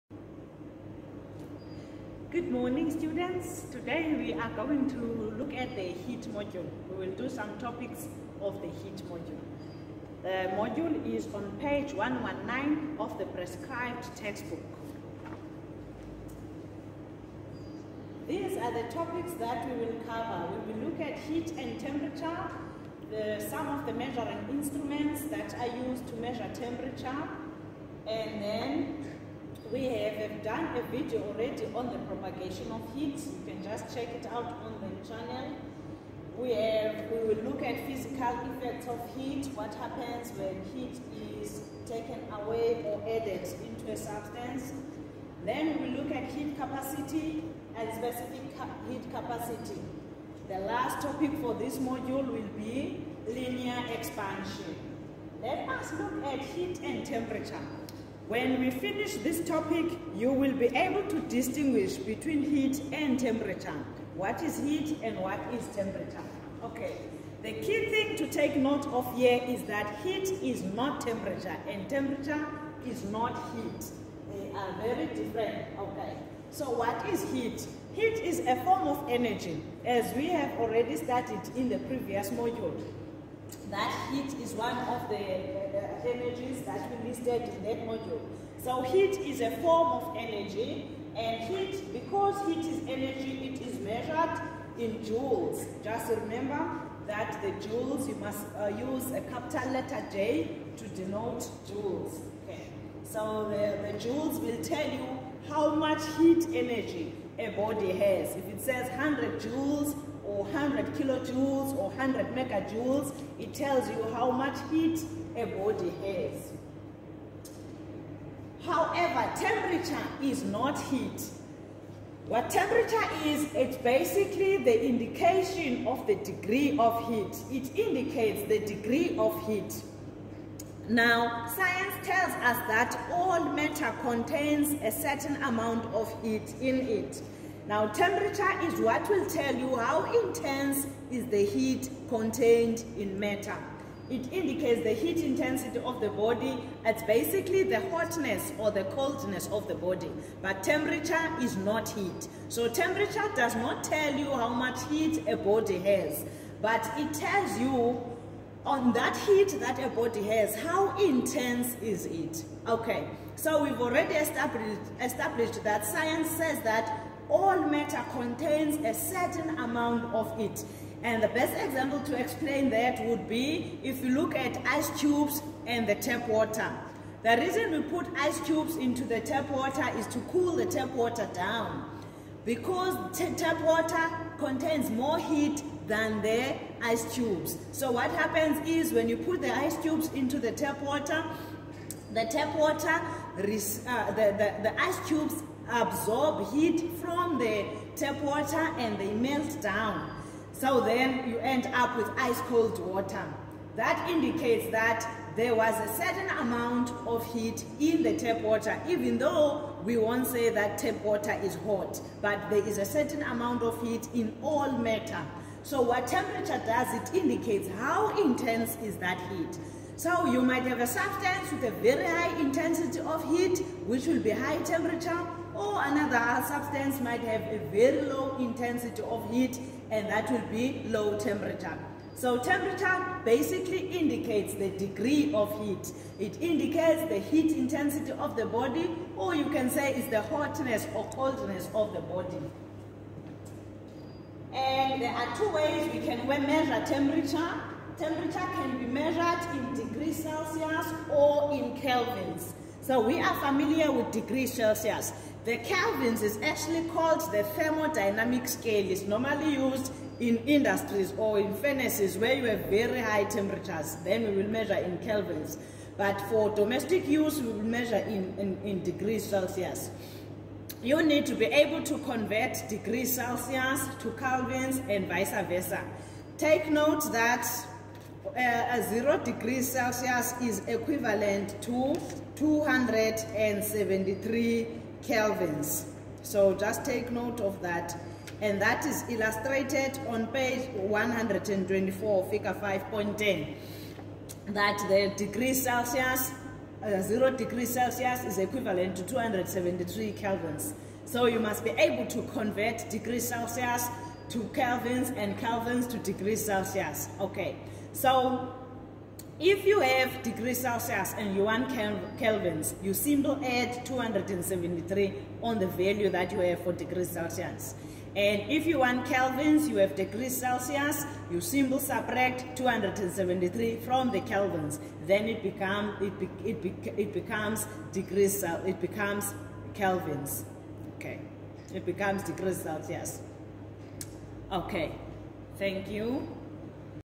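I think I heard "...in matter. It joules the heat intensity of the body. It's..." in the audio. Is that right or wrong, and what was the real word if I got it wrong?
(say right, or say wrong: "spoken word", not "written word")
wrong: "indicates", not "joules".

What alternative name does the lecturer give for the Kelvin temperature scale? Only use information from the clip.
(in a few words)
Thermodynamic scale.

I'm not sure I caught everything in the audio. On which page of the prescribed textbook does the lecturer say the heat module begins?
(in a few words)
119.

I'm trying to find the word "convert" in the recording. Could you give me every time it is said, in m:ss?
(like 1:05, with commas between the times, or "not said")
4:31, 5:02.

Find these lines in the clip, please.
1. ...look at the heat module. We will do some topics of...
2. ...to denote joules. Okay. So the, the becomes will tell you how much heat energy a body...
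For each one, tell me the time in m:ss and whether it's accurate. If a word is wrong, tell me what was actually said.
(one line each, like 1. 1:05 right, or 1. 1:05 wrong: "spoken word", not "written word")
1. 0:05 right
2. 1:40 wrong: "joules", not "becomes".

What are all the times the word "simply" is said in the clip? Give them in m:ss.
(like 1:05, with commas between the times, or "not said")
5:12, 5:21.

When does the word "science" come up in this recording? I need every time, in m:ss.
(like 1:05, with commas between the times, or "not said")
2:11, 2:45.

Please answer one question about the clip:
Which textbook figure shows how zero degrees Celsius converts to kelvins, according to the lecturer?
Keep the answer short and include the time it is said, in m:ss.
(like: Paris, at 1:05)
Figure 5.10, at 4:52.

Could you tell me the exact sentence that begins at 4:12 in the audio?
So we are familiar with degrees Celsius.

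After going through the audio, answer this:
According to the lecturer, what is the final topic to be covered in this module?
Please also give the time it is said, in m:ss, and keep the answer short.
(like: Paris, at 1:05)
Linear expansion, at 0:53.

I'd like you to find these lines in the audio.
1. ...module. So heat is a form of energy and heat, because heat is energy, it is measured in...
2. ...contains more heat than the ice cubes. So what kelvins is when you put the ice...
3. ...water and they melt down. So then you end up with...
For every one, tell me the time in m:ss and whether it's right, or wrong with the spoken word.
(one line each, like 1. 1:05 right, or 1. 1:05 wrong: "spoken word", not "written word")
1. 1:27 right
2. 3:04 wrong: "happens", not "kelvins"
3. 3:18 right.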